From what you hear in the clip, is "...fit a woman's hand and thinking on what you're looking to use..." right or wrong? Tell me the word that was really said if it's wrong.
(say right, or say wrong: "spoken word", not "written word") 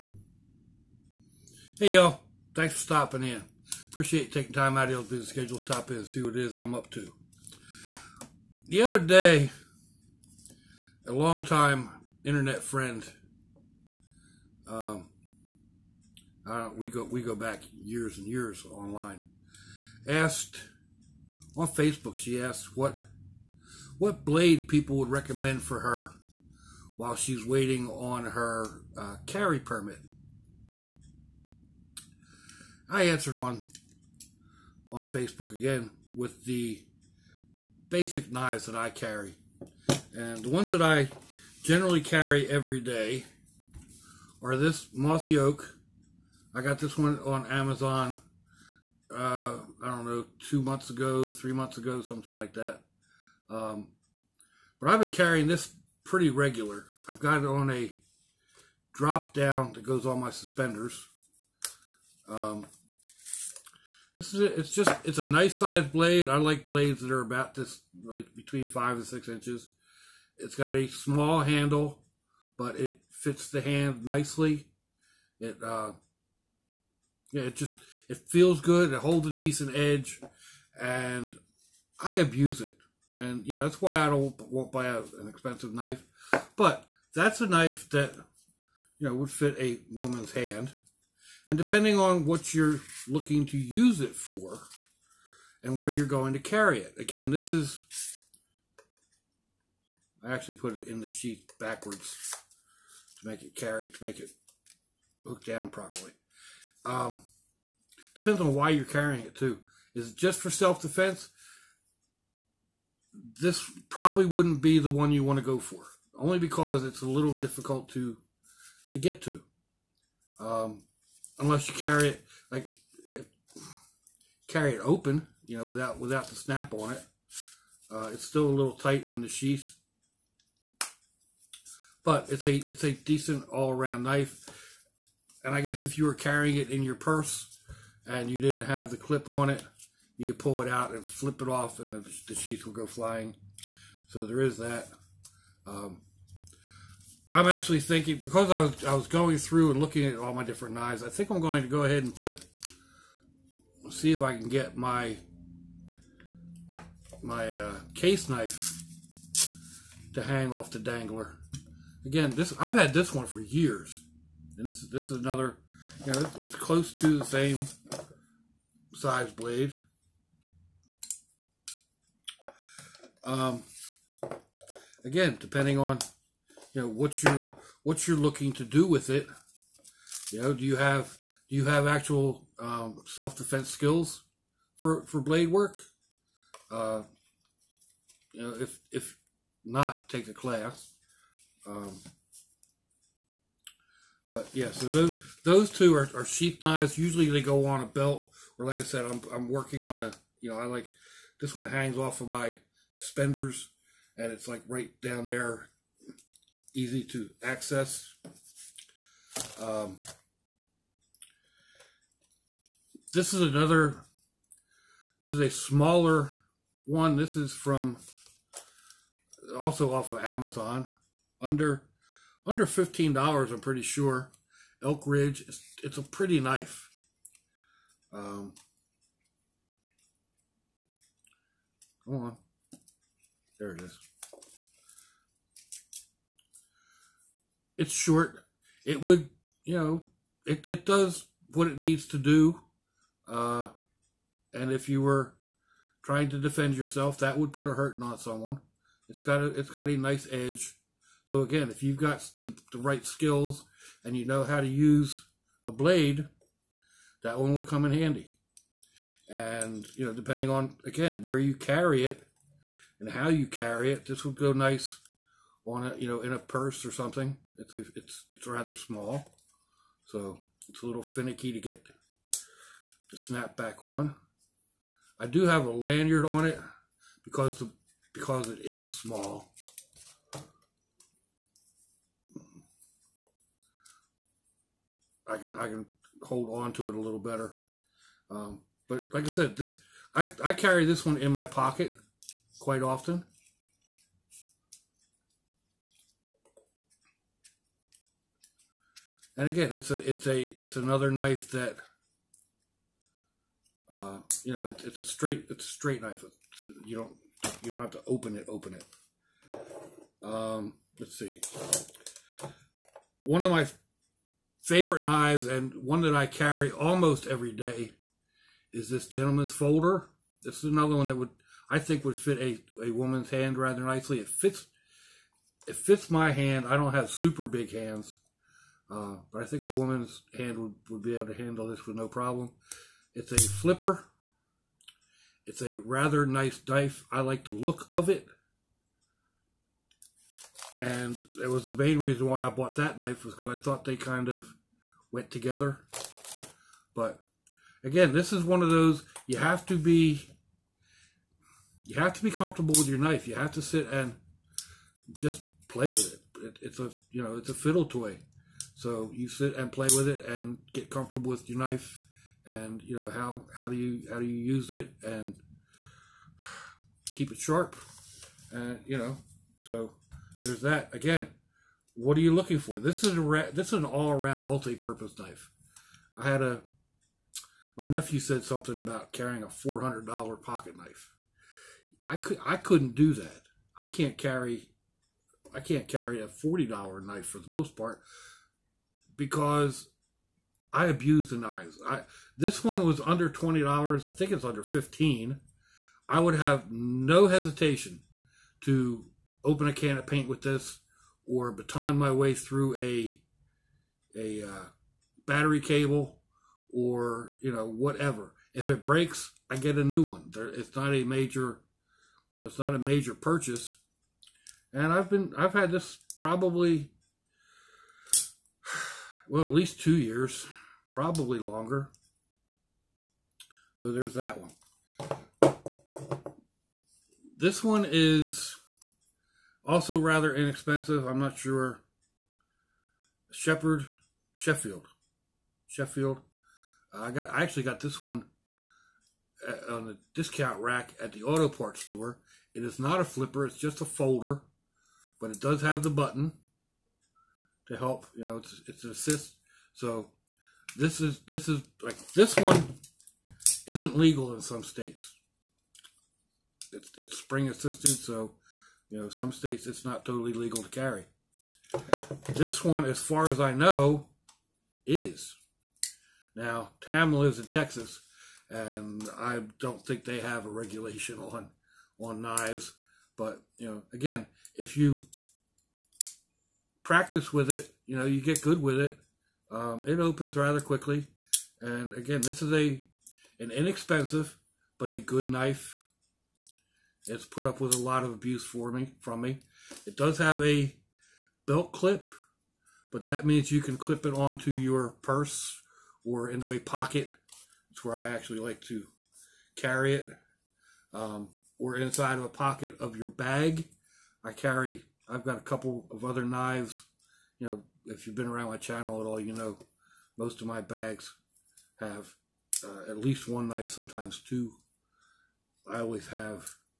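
wrong: "depending", not "thinking".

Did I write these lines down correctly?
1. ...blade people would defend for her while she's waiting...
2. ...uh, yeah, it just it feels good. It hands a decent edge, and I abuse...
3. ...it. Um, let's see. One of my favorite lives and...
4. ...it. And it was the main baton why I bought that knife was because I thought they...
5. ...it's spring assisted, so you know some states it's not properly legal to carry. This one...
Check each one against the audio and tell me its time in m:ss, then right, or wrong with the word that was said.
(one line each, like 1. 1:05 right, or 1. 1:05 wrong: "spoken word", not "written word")
1. 0:24 wrong: "recommend", not "defend"
2. 1:15 wrong: "holds", not "hands"
3. 5:08 wrong: "knives", not "lives"
4. 5:38 wrong: "reason", not "baton"
5. 7:36 wrong: "totally", not "properly".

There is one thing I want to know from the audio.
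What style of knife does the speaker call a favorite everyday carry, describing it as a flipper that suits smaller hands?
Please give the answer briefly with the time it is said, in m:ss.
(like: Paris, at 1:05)
Gentleman's folder, at 5:19.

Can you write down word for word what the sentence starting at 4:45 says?
I can I can hold on to it a little better.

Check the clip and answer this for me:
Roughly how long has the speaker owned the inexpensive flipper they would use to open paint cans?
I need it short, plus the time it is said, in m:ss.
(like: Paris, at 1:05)
At least 2 years, at 6:59.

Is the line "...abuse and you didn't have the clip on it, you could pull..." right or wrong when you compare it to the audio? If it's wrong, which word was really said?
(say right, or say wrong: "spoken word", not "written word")
wrong: "purse", not "abuse".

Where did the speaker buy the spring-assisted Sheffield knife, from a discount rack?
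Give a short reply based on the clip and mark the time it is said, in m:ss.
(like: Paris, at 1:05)
Auto parts store, at 7:21.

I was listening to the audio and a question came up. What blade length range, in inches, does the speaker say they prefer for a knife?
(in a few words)
5 to 6 inches.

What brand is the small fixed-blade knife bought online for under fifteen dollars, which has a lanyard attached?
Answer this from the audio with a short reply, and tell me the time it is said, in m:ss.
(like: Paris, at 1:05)
Elk Ridge, at 3:44.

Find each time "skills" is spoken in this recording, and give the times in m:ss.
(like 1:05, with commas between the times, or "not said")
3:03, 4:13.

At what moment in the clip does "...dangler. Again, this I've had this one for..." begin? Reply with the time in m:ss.
2:40.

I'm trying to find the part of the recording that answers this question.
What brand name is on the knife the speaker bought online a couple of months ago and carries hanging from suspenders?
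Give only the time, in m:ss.
0:44.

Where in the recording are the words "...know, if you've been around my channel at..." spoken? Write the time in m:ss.
8:27.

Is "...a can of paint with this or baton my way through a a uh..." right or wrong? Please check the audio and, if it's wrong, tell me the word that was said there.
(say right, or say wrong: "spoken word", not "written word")
right.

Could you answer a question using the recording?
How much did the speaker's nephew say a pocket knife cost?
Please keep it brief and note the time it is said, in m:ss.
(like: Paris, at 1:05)
$400, at 6:19.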